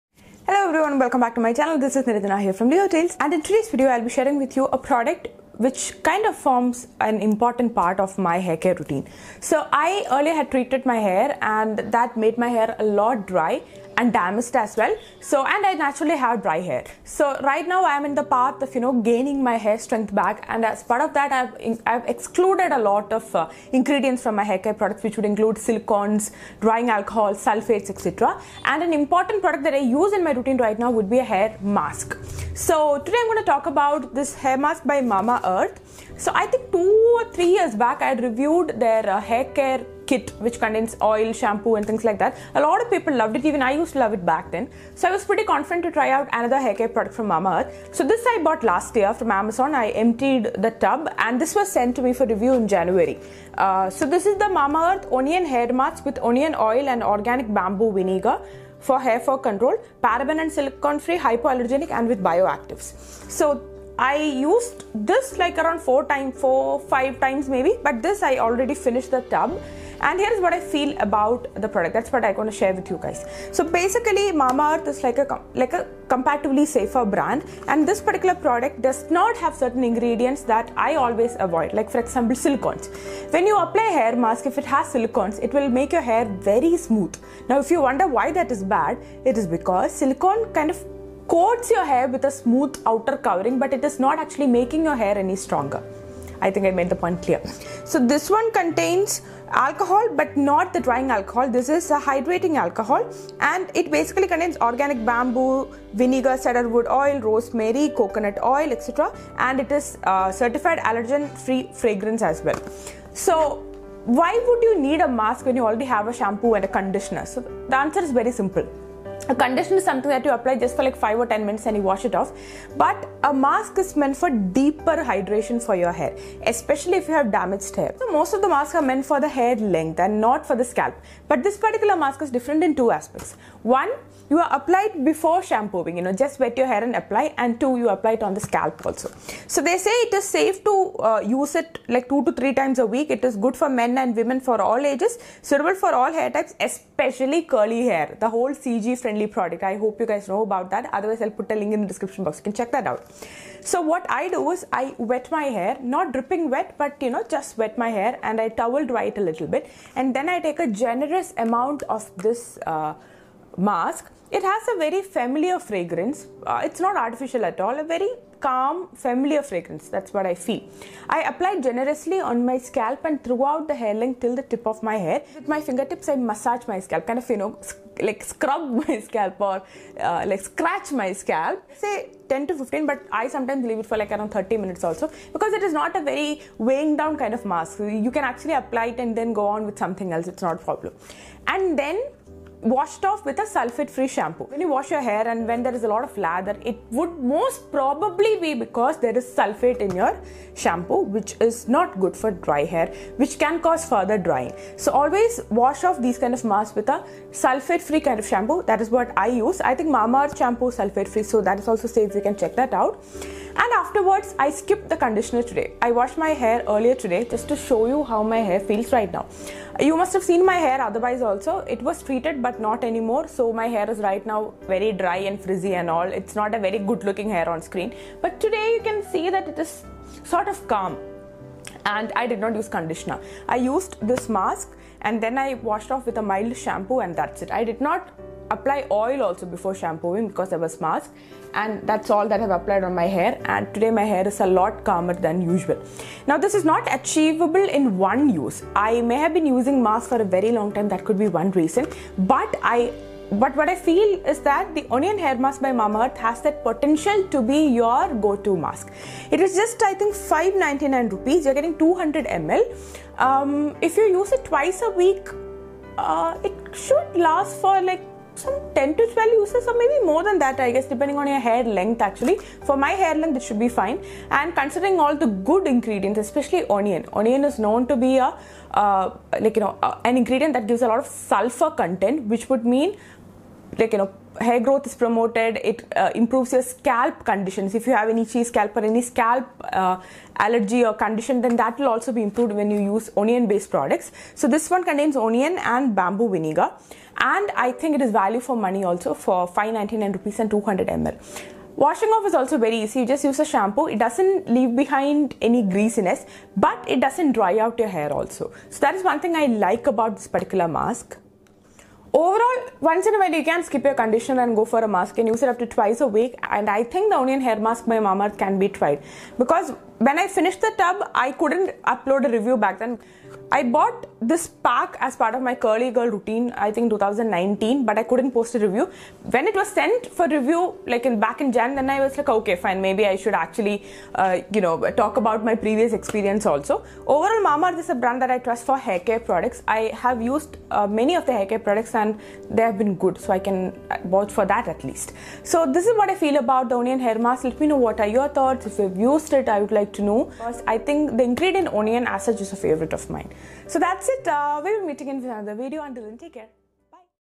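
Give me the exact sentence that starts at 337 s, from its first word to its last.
Overall, Mamaearth is a brand that I trust for hair care products.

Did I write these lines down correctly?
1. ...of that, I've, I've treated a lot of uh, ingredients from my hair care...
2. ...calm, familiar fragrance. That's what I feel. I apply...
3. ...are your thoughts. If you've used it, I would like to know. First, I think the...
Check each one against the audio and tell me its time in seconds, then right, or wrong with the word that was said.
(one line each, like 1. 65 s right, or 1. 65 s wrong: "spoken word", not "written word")
1. 21 s wrong: "excluded", not "treated"
2. 168 s right
3. 347 s right.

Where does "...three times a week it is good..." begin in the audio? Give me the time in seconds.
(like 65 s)
142 s.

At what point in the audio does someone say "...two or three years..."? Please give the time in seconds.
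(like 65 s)
36 s.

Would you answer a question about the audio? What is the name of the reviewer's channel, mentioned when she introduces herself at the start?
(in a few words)
Leo Tales.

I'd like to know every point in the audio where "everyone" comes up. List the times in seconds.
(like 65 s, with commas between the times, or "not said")
0 s.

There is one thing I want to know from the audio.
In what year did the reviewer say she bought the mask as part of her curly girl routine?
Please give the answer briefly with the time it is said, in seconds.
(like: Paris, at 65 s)
2019, at 326 s.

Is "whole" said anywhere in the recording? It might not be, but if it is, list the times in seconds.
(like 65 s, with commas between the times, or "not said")
148 s.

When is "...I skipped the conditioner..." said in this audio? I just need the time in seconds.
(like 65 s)
214 s.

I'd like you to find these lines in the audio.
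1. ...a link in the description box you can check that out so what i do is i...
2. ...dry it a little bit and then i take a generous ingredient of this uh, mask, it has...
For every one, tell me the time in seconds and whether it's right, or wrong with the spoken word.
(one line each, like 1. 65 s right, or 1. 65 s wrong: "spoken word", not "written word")
1. 151 s right
2. 158 s wrong: "amount", not "ingredient".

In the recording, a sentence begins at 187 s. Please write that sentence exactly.
You can actually apply it and then go on with something else.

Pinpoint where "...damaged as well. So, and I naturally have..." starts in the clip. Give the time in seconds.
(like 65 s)
14 s.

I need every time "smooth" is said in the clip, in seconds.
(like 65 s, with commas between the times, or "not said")
86 s, 92 s.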